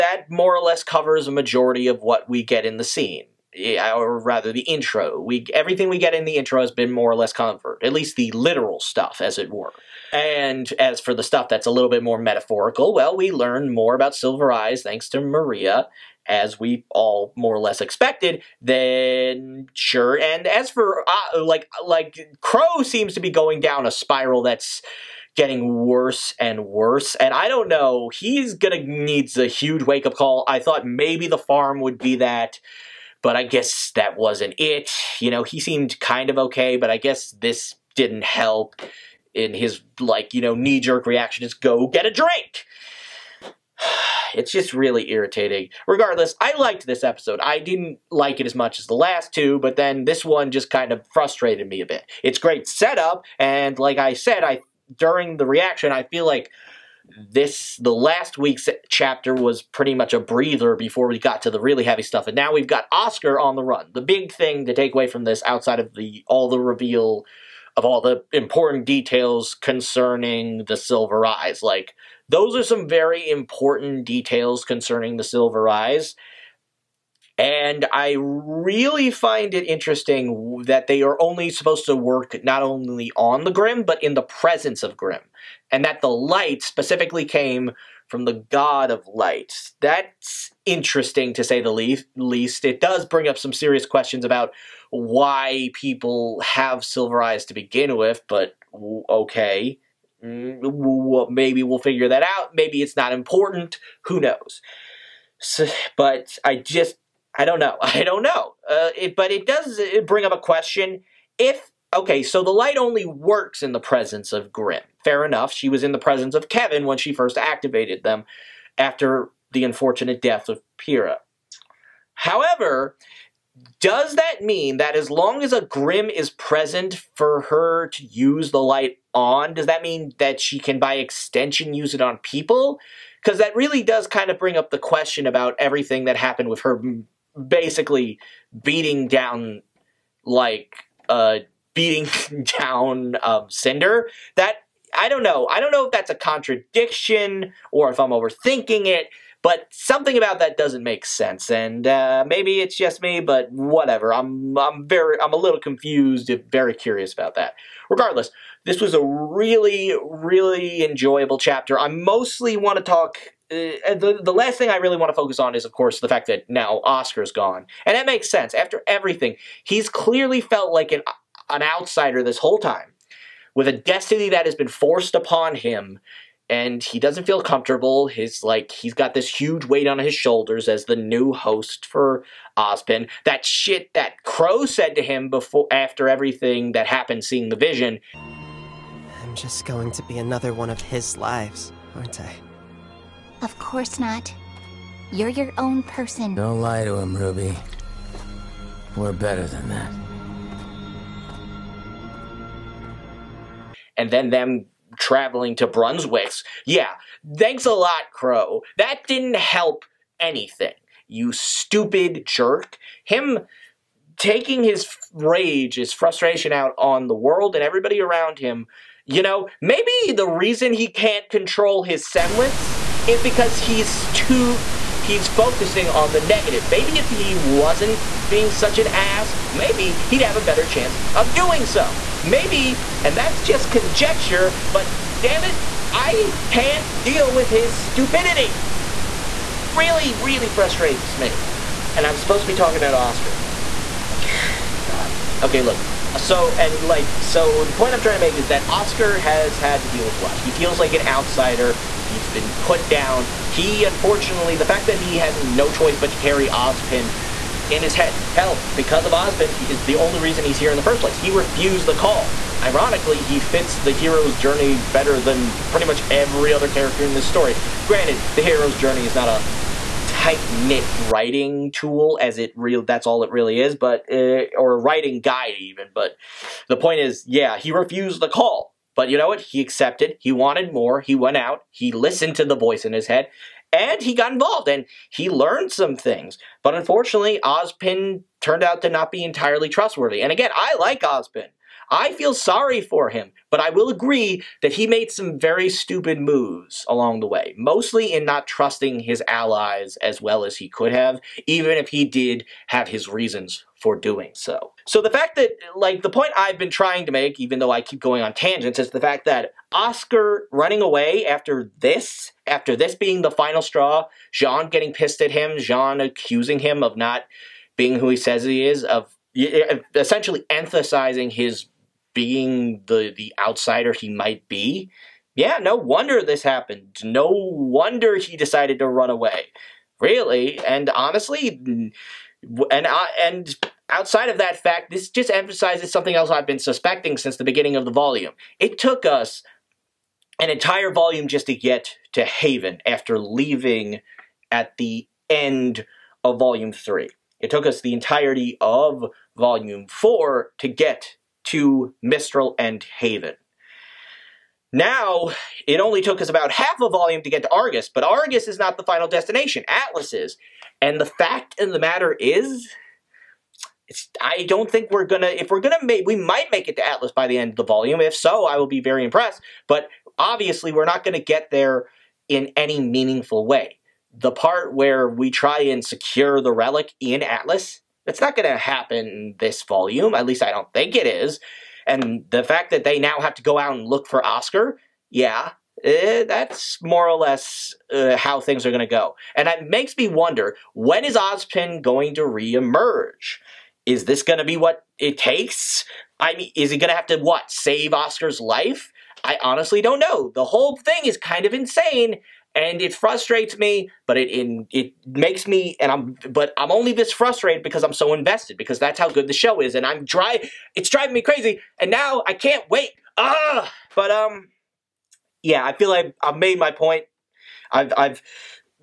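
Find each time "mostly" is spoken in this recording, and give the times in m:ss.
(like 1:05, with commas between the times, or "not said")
2:41, 4:57.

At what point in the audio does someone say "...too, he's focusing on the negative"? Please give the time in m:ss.
3:44.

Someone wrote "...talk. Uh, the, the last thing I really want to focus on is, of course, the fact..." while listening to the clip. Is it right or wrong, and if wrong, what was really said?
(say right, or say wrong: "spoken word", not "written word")
right.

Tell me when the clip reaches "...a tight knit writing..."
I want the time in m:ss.
4:29.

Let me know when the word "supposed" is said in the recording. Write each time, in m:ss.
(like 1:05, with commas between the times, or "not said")
1:21, 4:02.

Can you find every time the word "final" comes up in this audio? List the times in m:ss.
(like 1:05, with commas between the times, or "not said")
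5:13, 5:58.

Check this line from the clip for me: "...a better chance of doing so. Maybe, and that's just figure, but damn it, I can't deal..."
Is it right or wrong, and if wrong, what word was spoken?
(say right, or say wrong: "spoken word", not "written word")
wrong: "conjecture", not "figure".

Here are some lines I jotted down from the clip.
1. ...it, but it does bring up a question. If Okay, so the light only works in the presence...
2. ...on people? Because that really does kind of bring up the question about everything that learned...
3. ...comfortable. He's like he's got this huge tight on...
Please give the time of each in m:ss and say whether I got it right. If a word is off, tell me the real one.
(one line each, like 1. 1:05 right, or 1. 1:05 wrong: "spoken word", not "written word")
1. 1:48 right
2. 2:12 wrong: "happened", not "learned"
3. 2:57 wrong: "weight", not "tight".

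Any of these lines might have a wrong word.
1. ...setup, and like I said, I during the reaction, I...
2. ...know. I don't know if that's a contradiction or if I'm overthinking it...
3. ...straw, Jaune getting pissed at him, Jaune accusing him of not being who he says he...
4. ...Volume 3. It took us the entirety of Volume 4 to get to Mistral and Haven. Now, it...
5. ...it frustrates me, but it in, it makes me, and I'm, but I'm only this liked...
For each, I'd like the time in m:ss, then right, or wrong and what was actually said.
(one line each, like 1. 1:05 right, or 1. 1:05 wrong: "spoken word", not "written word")
1. 0:52 right
2. 2:25 right
3. 5:13 right
4. 5:46 right
5. 6:42 wrong: "frustrated", not "liked".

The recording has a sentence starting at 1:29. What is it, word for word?
That's interesting to say the least.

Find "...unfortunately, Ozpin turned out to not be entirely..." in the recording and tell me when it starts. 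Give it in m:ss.
4:46.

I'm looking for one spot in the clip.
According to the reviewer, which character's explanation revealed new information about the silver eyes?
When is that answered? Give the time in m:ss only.
0:15.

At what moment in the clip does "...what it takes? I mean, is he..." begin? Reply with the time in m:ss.
6:34.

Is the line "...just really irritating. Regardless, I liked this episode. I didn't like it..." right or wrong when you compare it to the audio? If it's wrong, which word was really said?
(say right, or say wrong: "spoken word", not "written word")
right.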